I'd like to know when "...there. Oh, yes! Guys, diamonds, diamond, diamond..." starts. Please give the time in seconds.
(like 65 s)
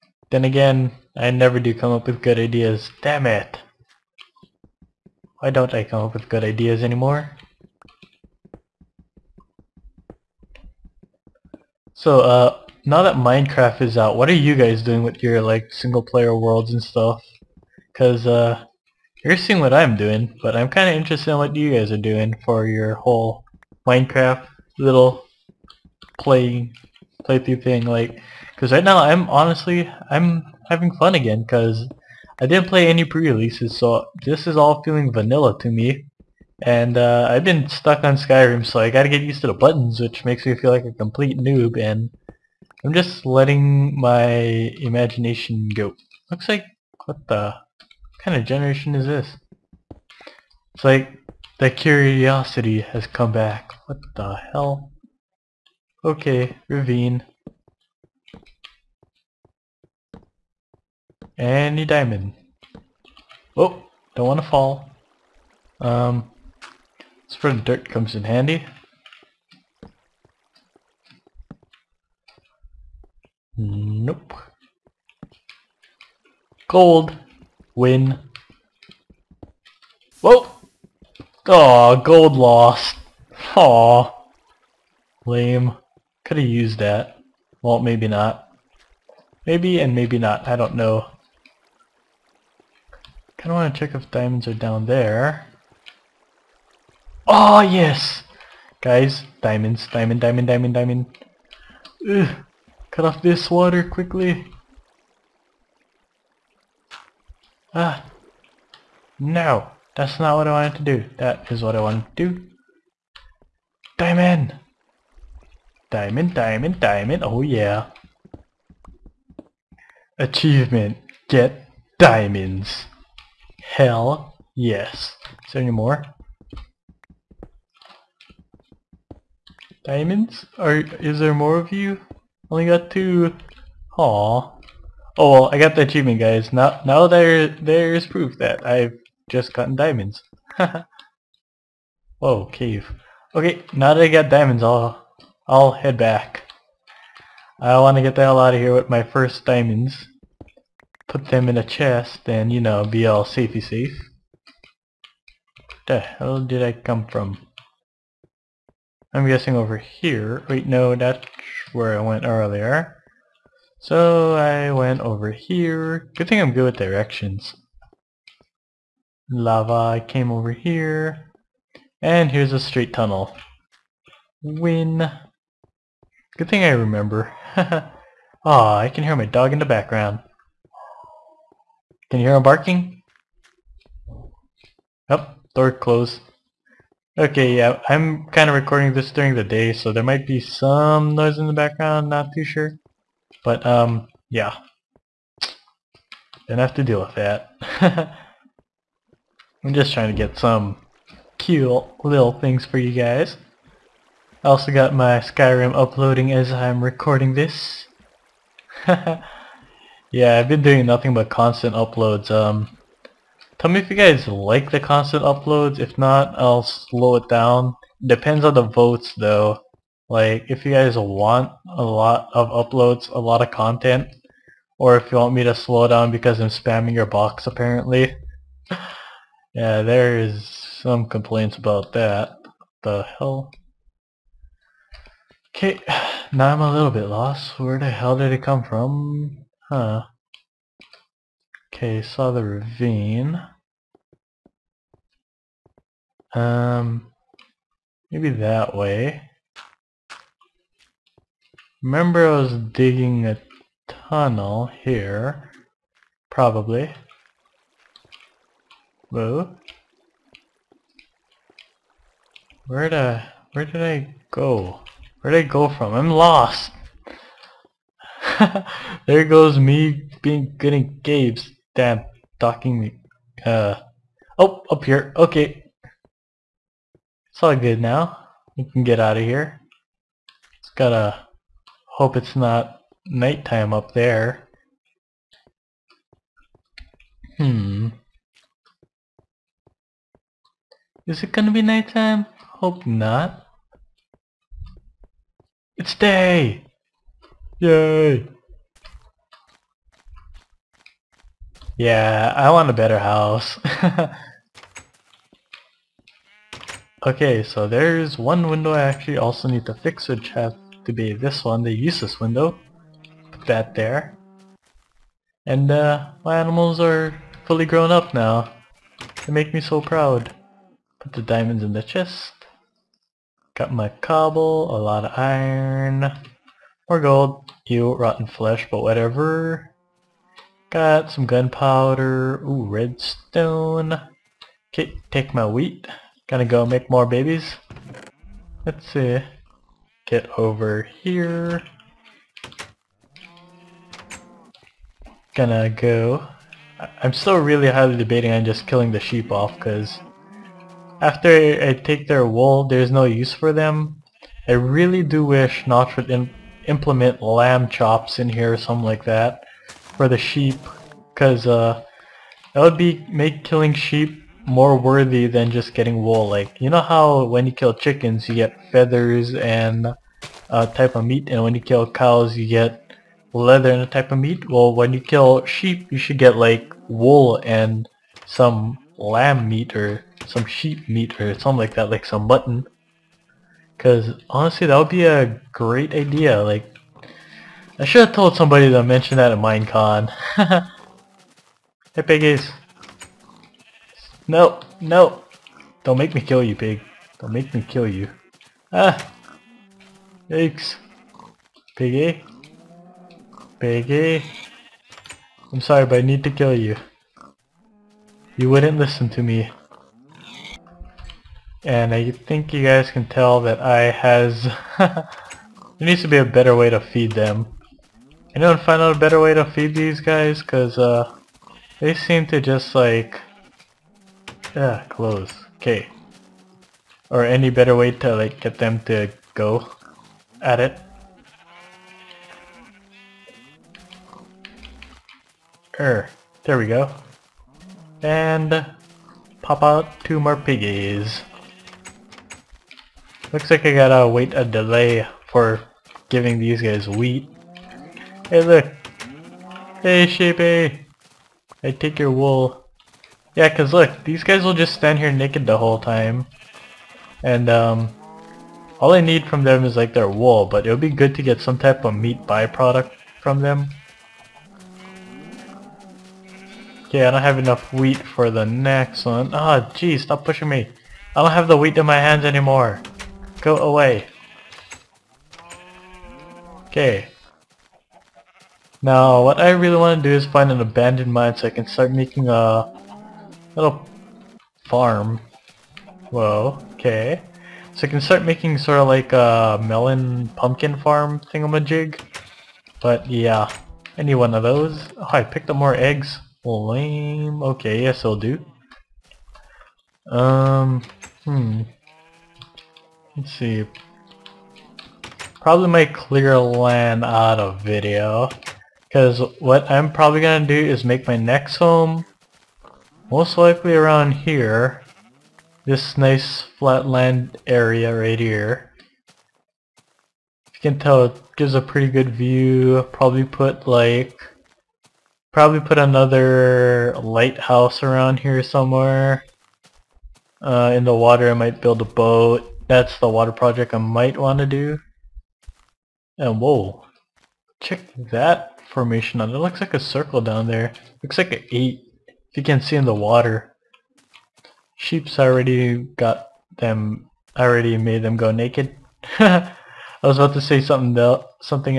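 94 s.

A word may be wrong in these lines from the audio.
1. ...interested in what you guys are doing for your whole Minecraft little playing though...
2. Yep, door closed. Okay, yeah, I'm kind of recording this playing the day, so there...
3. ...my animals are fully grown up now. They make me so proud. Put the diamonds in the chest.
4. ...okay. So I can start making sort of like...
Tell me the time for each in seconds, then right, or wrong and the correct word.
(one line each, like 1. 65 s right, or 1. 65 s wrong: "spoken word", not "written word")
1. 20 s wrong: "playthrough", not "though"
2. 185 s wrong: "during", not "playing"
3. 316 s right
4. 486 s right.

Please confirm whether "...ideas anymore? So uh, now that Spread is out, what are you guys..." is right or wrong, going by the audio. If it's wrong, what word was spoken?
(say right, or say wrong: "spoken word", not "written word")
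wrong: "Minecraft", not "Spread".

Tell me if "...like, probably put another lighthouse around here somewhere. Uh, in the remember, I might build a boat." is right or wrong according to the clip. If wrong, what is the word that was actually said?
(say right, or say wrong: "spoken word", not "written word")
wrong: "water", not "remember".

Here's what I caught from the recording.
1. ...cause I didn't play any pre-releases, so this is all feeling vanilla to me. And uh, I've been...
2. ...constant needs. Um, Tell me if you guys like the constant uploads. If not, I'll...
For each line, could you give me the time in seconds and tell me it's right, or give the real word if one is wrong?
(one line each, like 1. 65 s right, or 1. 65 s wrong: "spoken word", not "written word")
1. 31 s right
2. 211 s wrong: "uploads", not "needs".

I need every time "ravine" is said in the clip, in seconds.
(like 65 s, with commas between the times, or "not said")
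56 s, 242 s.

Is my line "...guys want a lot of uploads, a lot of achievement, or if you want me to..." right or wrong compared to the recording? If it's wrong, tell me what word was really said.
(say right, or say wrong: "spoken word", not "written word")
wrong: "content", not "achievement".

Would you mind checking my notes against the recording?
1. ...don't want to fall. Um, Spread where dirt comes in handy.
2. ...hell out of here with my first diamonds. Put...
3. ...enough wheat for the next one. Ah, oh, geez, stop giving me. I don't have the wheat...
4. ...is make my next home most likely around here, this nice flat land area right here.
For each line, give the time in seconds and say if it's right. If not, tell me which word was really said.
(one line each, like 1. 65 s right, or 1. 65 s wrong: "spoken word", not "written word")
1. 64 s right
2. 148 s right
3. 467 s wrong: "pushing", not "giving"
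4. 510 s right.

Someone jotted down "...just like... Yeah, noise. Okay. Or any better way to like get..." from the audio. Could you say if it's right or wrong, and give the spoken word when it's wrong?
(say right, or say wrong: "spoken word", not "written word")
wrong: "close", not "noise".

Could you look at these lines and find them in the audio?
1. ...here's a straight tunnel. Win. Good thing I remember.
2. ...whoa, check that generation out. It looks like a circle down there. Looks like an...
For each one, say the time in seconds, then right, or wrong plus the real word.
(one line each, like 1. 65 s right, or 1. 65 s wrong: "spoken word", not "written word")
1. 172 s right
2. 536 s wrong: "formation", not "generation".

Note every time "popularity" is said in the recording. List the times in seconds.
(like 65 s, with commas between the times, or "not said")
not said.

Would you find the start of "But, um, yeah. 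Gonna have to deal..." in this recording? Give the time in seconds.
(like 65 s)
193 s.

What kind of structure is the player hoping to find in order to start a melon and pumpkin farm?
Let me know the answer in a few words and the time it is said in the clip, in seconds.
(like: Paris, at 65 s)
abandoned mine, at 480 s.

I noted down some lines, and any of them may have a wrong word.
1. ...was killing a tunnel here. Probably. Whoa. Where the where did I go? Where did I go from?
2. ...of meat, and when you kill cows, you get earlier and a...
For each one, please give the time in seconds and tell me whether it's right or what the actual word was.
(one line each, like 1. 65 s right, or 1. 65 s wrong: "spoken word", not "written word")
1. 252 s wrong: "digging", not "killing"
2. 370 s wrong: "leather", not "earlier".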